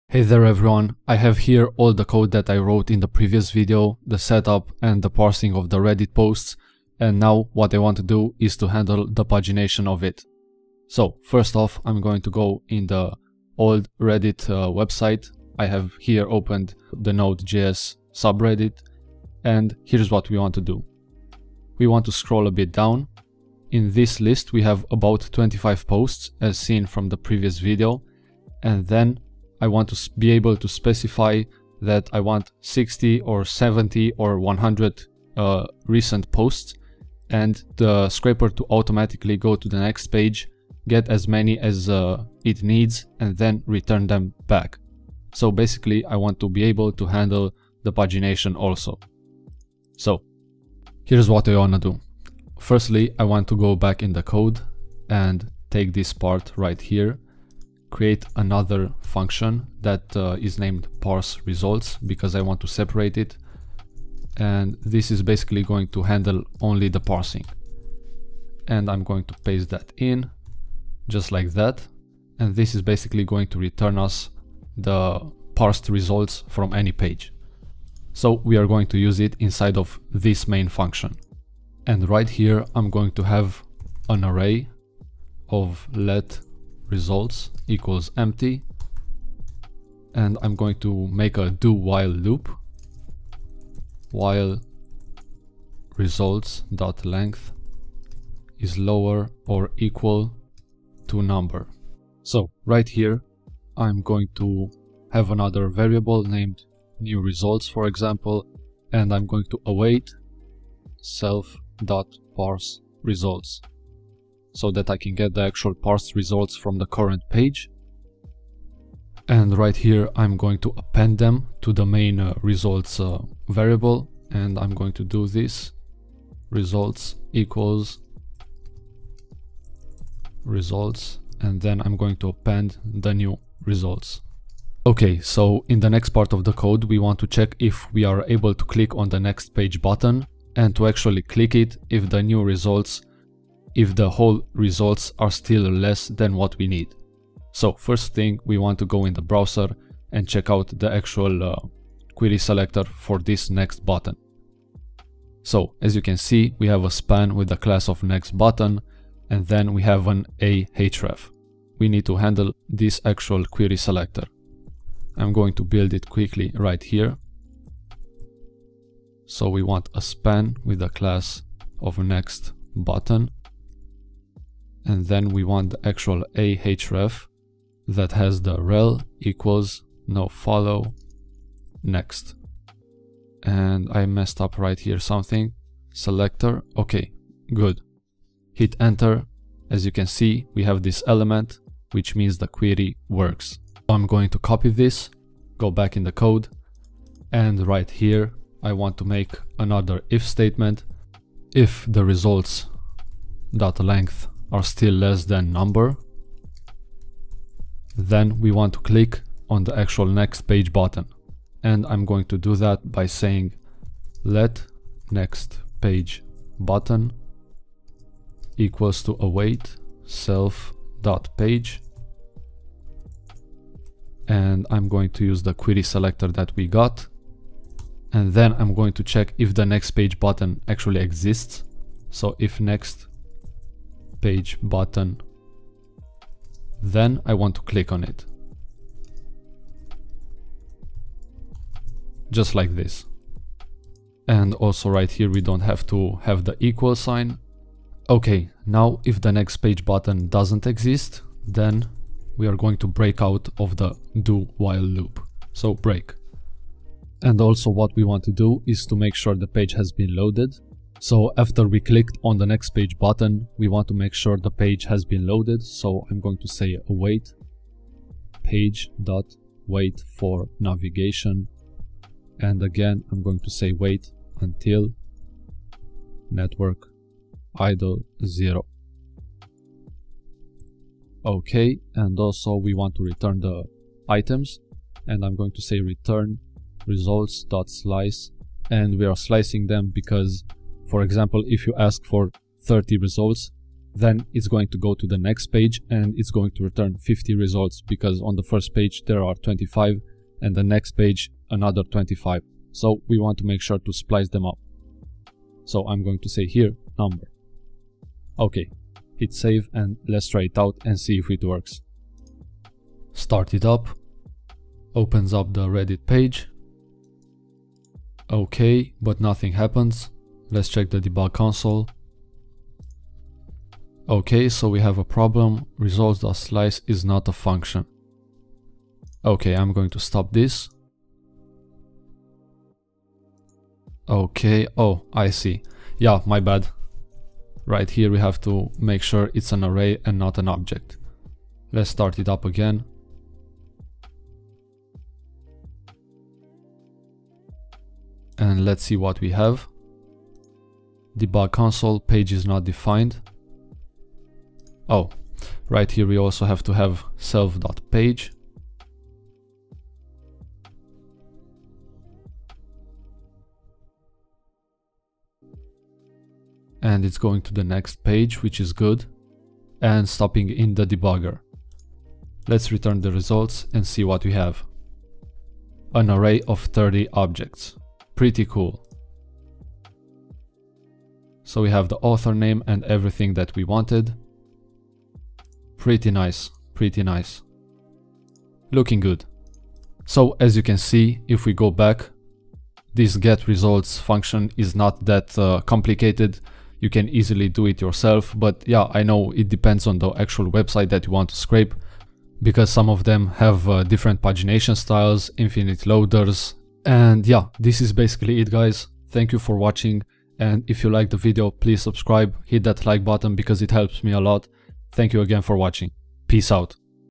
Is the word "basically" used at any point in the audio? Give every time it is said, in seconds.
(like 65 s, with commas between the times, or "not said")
45 s, 65 s, 72 s, 407 s.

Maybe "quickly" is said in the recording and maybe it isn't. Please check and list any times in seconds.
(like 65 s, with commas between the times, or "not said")
166 s.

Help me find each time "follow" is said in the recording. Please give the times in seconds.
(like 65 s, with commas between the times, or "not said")
180 s.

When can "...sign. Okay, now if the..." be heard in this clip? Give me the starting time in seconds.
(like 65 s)
246 s.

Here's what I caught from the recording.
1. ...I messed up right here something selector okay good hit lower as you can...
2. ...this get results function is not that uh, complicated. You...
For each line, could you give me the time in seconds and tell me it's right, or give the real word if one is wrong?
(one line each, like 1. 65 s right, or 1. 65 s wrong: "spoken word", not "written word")
1. 183 s wrong: "enter", not "lower"
2. 392 s right.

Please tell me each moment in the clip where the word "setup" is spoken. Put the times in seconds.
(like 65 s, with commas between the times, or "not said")
4 s.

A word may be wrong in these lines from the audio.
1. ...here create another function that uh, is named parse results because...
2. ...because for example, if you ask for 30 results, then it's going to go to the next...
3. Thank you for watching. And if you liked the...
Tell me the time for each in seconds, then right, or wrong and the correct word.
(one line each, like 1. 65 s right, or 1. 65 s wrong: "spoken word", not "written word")
1. 56 s right
2. 289 s right
3. 409 s right.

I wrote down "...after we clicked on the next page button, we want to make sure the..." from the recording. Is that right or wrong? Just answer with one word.
right.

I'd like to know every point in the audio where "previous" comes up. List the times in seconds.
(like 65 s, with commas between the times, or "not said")
3 s, 27 s.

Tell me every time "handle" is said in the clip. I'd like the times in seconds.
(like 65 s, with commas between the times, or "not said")
8 s, 47 s, 66 s, 162 s.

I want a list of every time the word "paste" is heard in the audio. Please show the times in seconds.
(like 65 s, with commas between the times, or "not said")
69 s.